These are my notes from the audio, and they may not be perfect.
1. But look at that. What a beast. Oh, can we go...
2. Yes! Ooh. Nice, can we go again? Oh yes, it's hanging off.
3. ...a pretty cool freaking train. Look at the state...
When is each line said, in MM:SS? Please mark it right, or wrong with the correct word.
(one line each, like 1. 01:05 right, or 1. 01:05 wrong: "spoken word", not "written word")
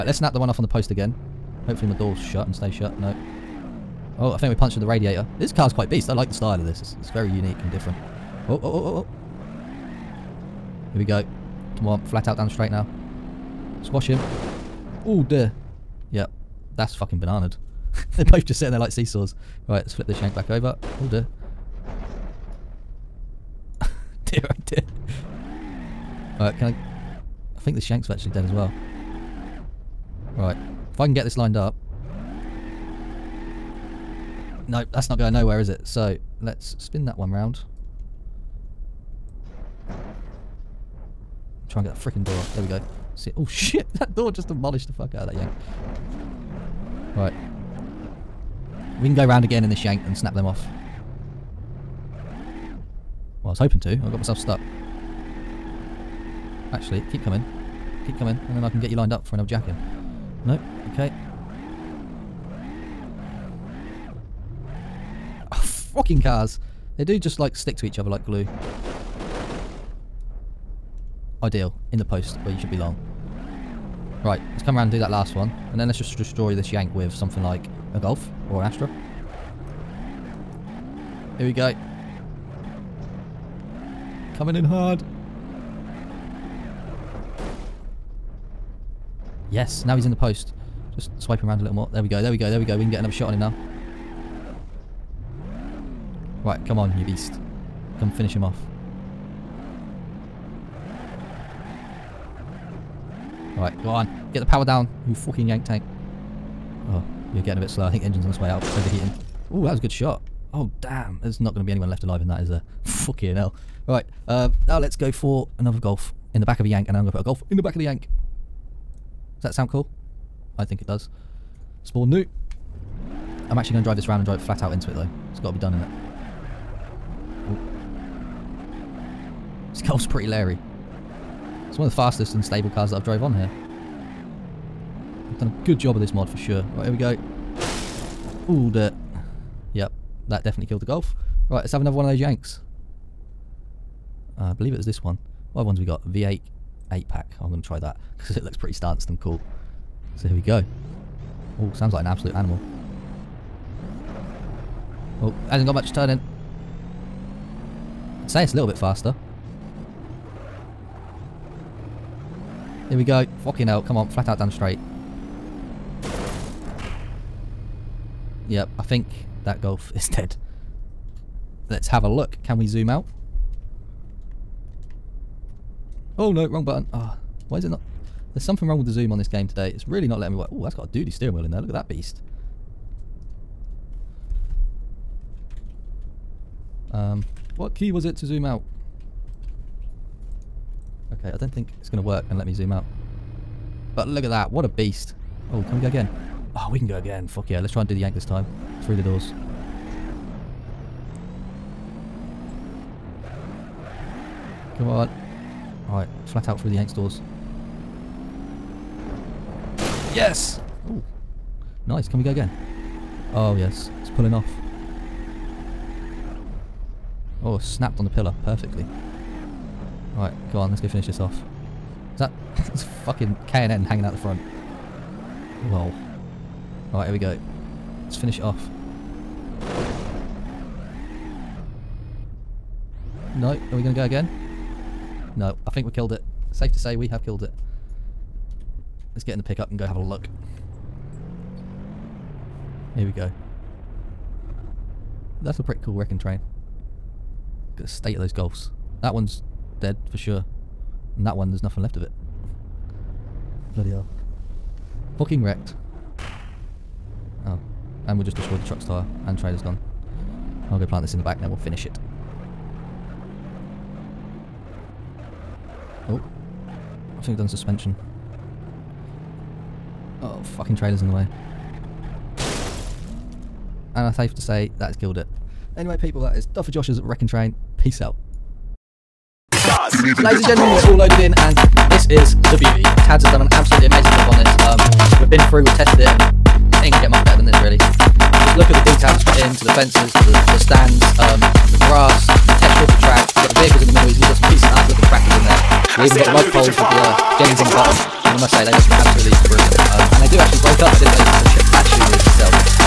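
1. 03:13 right
2. 03:30 wrong: "pulling", not "hanging"
3. 04:05 wrong: "wrecking", not "freaking".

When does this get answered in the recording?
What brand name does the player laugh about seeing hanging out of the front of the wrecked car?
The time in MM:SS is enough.
03:43.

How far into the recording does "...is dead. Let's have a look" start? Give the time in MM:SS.
02:49.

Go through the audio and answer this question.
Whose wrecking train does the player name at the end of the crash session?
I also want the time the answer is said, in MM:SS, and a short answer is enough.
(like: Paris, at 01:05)
Duffer Josh, at 04:36.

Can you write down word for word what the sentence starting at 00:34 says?
No, that's not going nowhere, is it?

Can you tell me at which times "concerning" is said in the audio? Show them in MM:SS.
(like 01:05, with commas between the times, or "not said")
not said.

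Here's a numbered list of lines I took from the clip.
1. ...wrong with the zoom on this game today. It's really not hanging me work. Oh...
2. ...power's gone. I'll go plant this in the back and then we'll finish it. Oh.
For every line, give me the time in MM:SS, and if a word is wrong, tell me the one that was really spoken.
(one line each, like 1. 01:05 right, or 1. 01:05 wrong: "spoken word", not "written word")
1. 02:58 wrong: "letting", not "hanging"
2. 04:19 wrong: "trailer", not "power".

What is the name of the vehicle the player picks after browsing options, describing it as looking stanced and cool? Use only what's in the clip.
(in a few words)
V8 8 pack.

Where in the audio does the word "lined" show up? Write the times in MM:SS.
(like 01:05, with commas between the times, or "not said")
00:31, 00:58.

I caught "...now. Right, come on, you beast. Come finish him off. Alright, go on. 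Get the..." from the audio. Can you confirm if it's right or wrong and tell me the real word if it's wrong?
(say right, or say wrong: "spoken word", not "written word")
right.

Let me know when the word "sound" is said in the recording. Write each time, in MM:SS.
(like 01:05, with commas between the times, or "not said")
01:59, 02:31.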